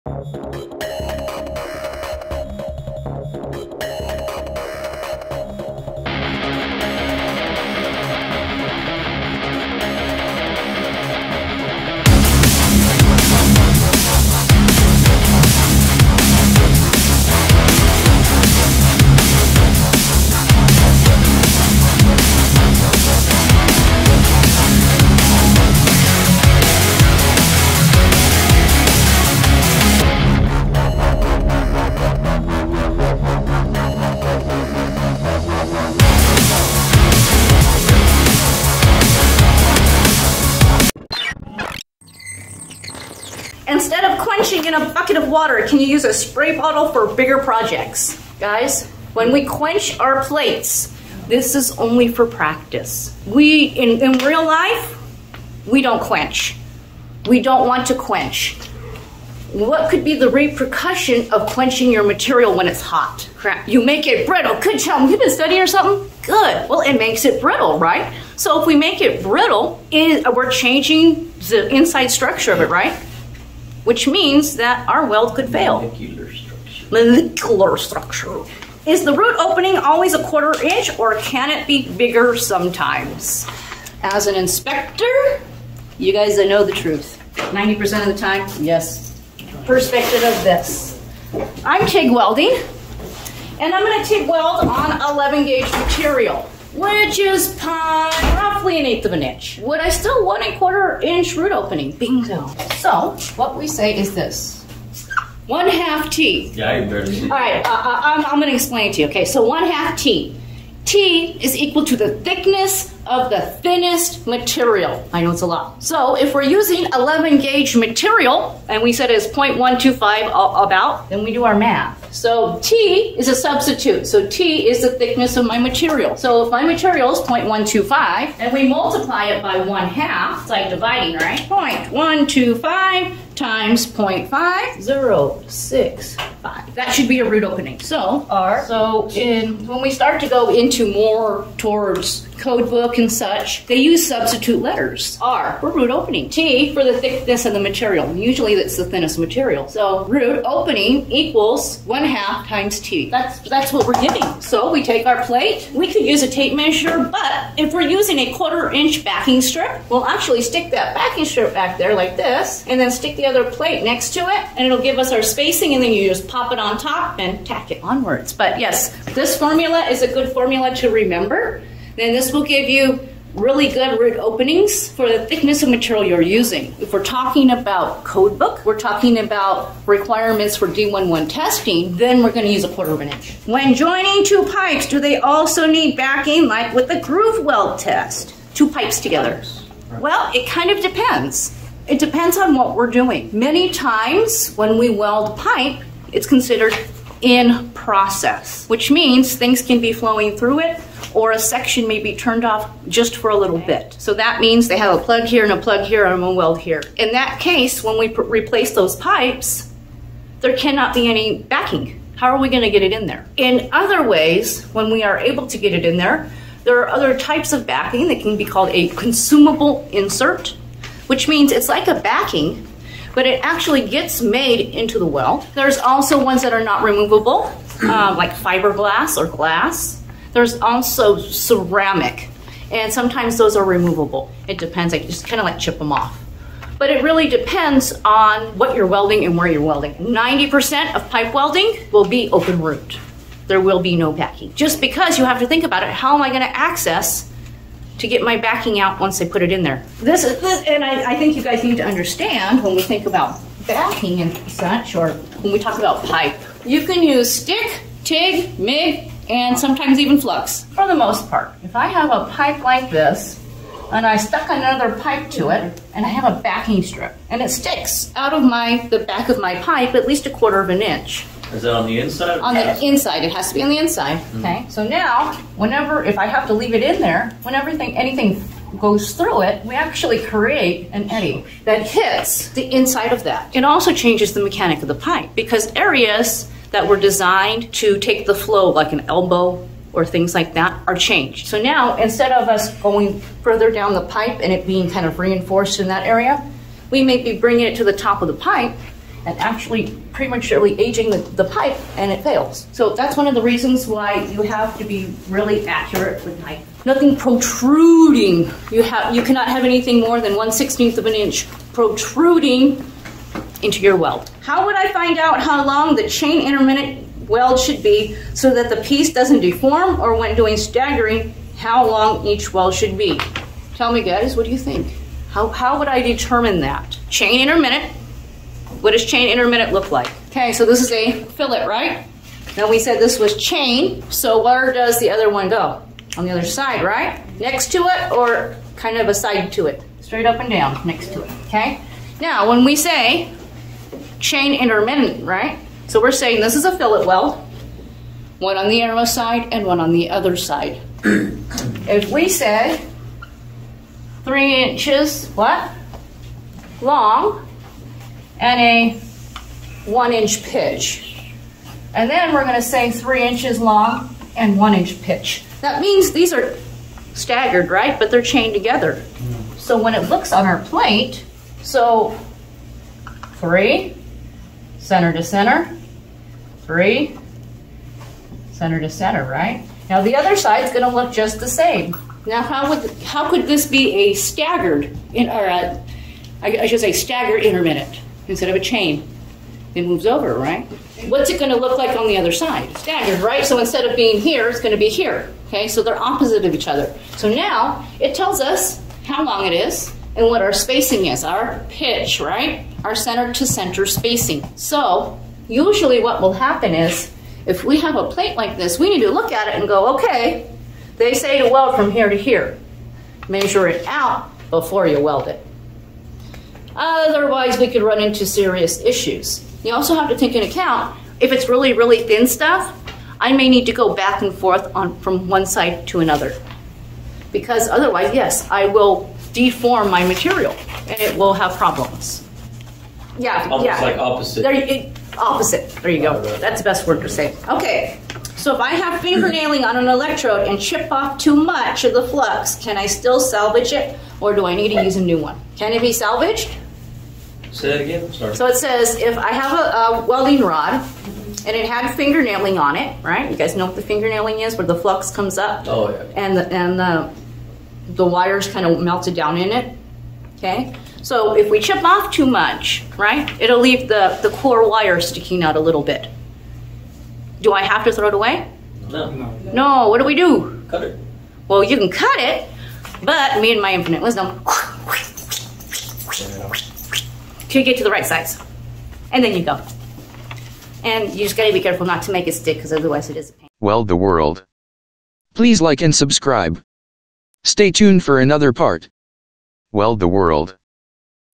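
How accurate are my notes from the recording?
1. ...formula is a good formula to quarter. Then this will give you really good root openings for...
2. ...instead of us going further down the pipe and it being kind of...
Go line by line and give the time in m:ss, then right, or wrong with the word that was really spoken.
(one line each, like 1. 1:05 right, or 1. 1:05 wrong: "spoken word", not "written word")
1. 2:49 wrong: "remember", not "quarter"
2. 4:51 right.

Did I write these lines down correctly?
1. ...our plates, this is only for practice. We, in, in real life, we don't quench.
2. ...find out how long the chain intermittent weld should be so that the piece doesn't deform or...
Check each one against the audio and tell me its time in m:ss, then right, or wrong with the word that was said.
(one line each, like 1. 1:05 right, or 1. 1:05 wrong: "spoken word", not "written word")
1. 0:49 right
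2. 5:14 right.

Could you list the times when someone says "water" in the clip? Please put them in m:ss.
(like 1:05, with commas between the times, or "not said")
0:45.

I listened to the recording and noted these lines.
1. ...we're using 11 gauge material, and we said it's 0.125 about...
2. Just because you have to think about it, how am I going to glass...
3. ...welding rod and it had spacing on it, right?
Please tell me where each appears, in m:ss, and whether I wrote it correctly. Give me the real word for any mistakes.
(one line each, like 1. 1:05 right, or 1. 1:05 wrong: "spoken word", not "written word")
1. 1:56 right
2. 4:04 wrong: "access", not "glass"
3. 7:30 wrong: "fingernailing", not "spacing".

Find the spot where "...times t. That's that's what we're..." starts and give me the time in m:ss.
2:32.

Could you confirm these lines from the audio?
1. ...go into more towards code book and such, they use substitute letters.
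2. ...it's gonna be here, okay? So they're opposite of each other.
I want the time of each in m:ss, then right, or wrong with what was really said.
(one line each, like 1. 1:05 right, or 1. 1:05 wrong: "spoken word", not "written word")
1. 2:20 right
2. 6:34 right.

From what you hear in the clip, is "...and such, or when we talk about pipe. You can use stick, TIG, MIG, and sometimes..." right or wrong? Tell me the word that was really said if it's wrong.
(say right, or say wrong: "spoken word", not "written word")
right.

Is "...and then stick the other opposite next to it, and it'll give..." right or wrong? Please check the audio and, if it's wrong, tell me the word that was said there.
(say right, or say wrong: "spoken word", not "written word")
wrong: "plate", not "opposite".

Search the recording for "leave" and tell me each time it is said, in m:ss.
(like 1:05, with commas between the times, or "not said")
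4:36, 7:43.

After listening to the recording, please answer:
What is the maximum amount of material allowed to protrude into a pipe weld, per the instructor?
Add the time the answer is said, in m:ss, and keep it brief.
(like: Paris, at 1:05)
1/16 inch, at 5:10.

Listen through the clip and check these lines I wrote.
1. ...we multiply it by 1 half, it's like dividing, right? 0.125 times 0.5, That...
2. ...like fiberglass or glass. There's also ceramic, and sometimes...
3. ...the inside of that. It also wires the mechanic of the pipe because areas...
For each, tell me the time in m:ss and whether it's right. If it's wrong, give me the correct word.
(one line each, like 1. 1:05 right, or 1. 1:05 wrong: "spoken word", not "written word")
1. 2:08 right
2. 3:48 right
3. 4:42 wrong: "changes", not "wires".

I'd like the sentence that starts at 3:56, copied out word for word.
But it really depends on what you're welding and where you're welding.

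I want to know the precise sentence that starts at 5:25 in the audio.
How, how would I determine that?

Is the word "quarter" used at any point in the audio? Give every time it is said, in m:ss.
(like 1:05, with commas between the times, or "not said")
1:20, 1:40, 2:38, 3:02, 4:30.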